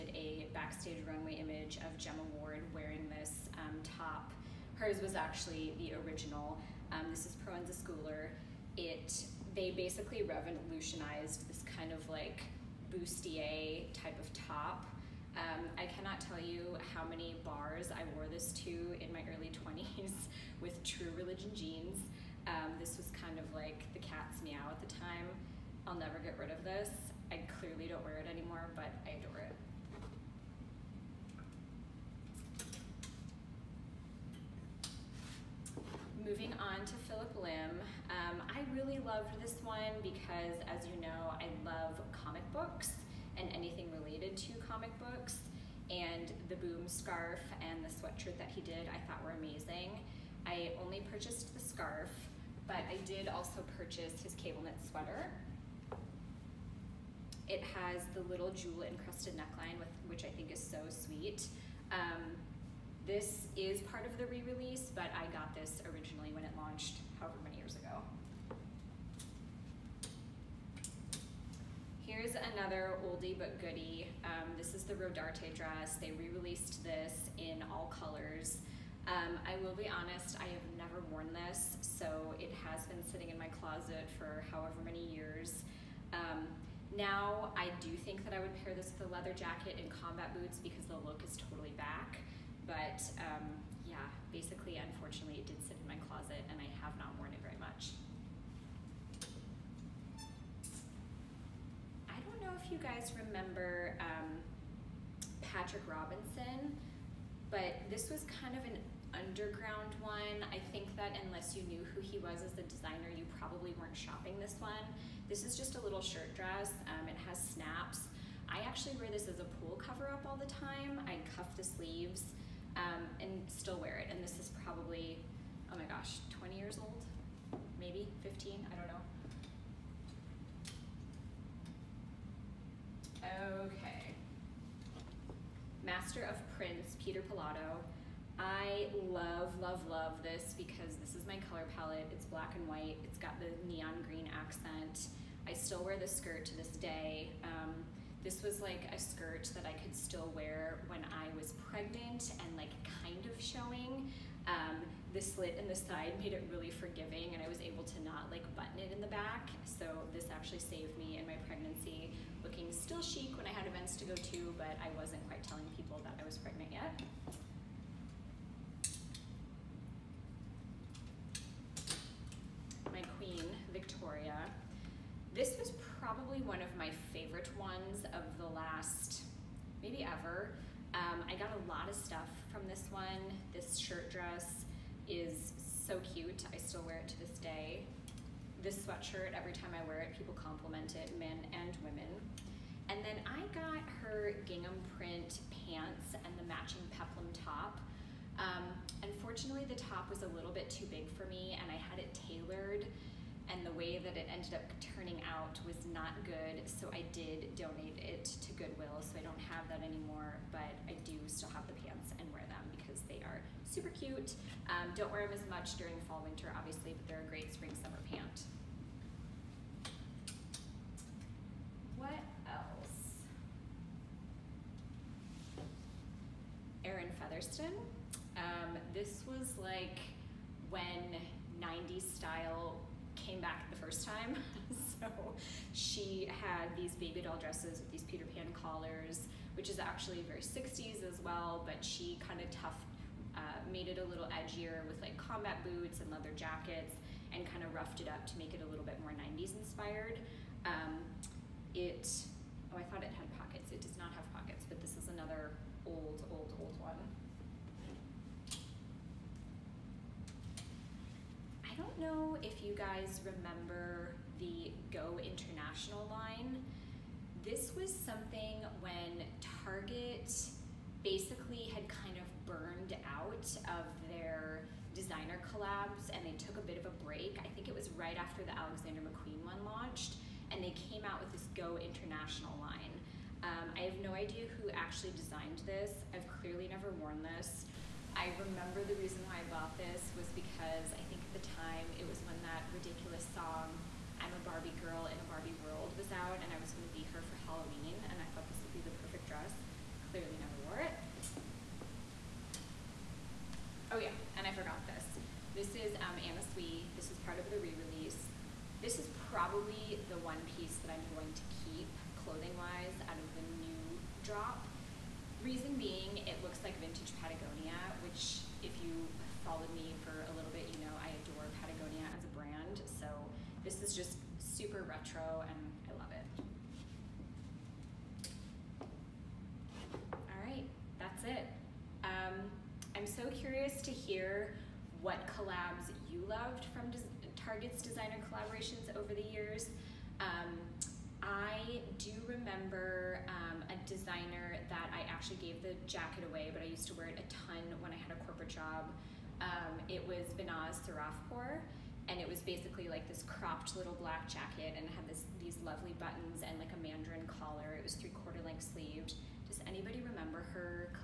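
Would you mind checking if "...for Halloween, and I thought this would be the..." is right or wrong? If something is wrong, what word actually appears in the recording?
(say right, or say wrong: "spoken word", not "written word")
right.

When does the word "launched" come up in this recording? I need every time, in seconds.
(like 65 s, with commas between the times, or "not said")
66 s, 279 s.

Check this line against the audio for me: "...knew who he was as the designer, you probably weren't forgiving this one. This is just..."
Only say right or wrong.
wrong.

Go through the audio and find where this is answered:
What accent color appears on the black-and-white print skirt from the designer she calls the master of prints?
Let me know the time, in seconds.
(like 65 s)
143 s.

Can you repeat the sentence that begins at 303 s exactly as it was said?
Oh, yeah, and I forgot this.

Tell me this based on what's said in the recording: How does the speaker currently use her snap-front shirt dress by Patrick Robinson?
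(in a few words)
pool cover up.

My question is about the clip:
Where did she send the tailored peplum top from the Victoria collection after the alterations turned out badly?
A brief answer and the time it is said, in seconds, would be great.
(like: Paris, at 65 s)
Goodwill, at 208 s.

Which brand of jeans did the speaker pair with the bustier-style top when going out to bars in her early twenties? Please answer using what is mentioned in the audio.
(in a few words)
True Religion.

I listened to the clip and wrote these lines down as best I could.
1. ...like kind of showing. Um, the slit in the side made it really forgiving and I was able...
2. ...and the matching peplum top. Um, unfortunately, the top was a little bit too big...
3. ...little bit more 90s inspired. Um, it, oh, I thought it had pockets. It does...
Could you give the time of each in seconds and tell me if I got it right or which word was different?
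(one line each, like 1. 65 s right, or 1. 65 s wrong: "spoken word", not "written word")
1. 152 s right
2. 196 s right
3. 248 s right.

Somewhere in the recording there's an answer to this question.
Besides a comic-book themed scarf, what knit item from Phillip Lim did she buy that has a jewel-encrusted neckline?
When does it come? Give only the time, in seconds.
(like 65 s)
54 s.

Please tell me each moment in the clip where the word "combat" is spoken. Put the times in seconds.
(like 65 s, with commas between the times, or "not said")
89 s, 245 s.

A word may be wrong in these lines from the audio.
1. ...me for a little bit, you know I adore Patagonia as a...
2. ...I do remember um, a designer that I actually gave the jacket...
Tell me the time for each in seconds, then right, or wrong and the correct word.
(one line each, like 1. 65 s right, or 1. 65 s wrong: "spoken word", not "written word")
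1. 319 s right
2. 341 s right.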